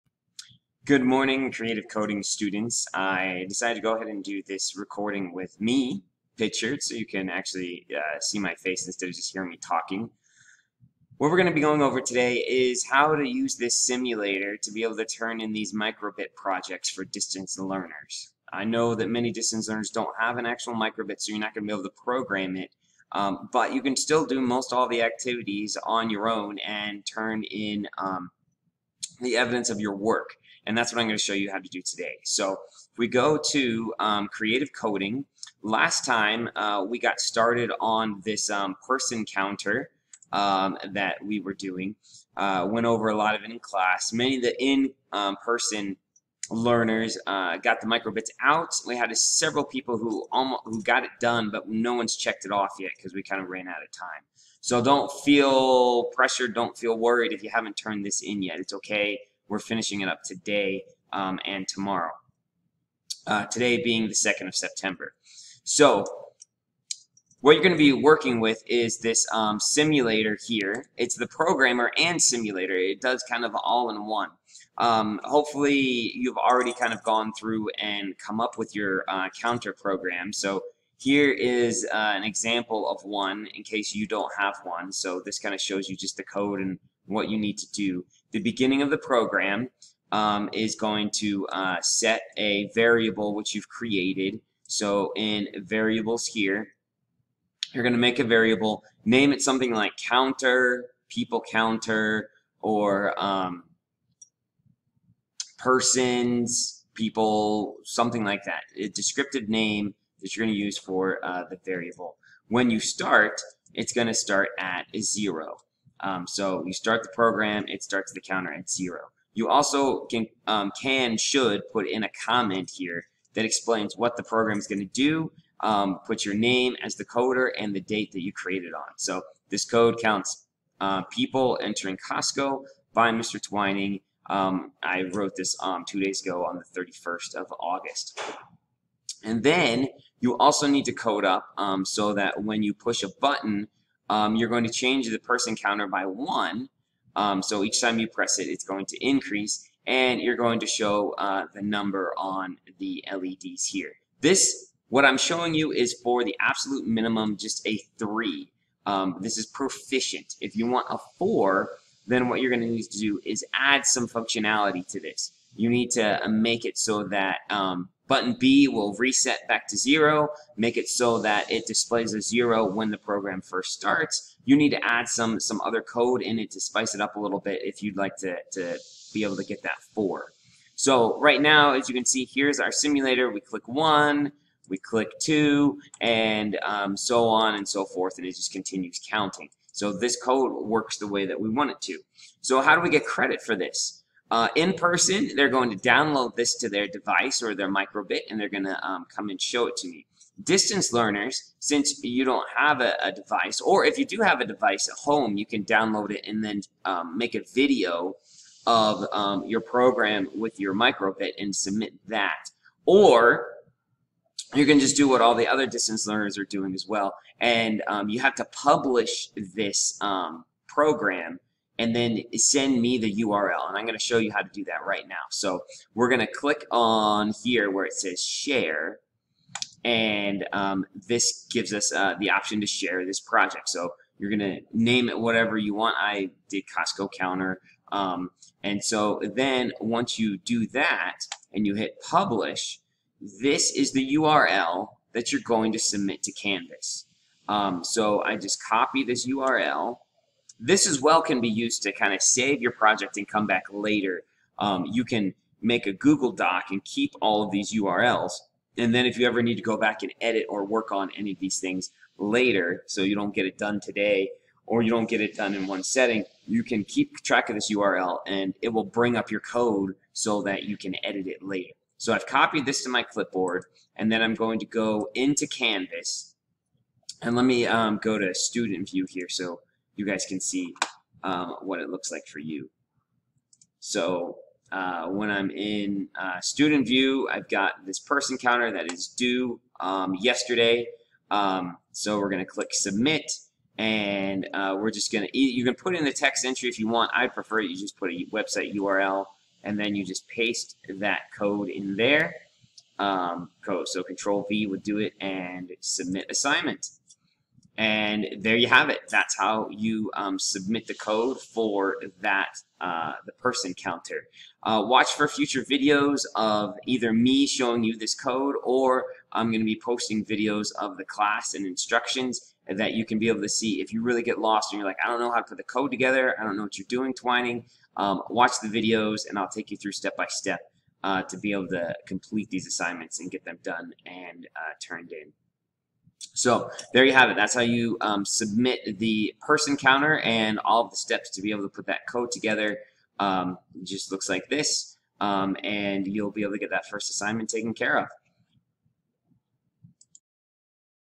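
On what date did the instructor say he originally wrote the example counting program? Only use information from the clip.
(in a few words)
31st of August.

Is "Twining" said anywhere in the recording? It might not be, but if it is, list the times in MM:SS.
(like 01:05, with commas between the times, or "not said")
02:13, 05:27.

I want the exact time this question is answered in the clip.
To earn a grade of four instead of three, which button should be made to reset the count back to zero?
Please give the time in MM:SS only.
02:48.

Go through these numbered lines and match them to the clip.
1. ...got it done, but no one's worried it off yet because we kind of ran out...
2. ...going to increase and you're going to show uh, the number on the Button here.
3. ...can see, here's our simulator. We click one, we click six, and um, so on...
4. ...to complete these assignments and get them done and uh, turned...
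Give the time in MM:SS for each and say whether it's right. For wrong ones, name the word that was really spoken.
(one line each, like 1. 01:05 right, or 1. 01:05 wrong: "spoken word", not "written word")
1. 00:50 wrong: "checked", not "worried"
2. 02:28 wrong: "LEDs", not "Button"
3. 03:01 wrong: "two", not "six"
4. 05:31 right.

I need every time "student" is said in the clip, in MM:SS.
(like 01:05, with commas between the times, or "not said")
00:02, 04:38, 04:46.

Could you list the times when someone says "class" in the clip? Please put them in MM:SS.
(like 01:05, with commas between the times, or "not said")
00:43, 05:21.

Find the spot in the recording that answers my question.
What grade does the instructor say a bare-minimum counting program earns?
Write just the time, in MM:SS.
02:39.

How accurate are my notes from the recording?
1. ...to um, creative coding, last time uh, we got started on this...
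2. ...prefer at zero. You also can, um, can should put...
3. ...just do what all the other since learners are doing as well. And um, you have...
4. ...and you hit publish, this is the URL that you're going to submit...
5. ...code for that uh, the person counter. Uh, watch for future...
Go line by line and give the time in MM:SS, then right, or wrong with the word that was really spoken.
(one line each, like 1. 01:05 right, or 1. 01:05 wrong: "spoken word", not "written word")
1. 00:33 right
2. 01:58 wrong: "counter", not "prefer"
3. 03:34 wrong: "distance", not "since"
4. 04:01 right
5. 05:10 right.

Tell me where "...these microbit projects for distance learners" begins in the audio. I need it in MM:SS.
00:15.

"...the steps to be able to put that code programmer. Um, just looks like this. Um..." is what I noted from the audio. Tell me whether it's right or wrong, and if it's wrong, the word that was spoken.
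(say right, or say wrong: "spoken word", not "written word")
wrong: "together", not "programmer".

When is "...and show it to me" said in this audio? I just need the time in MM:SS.
03:19.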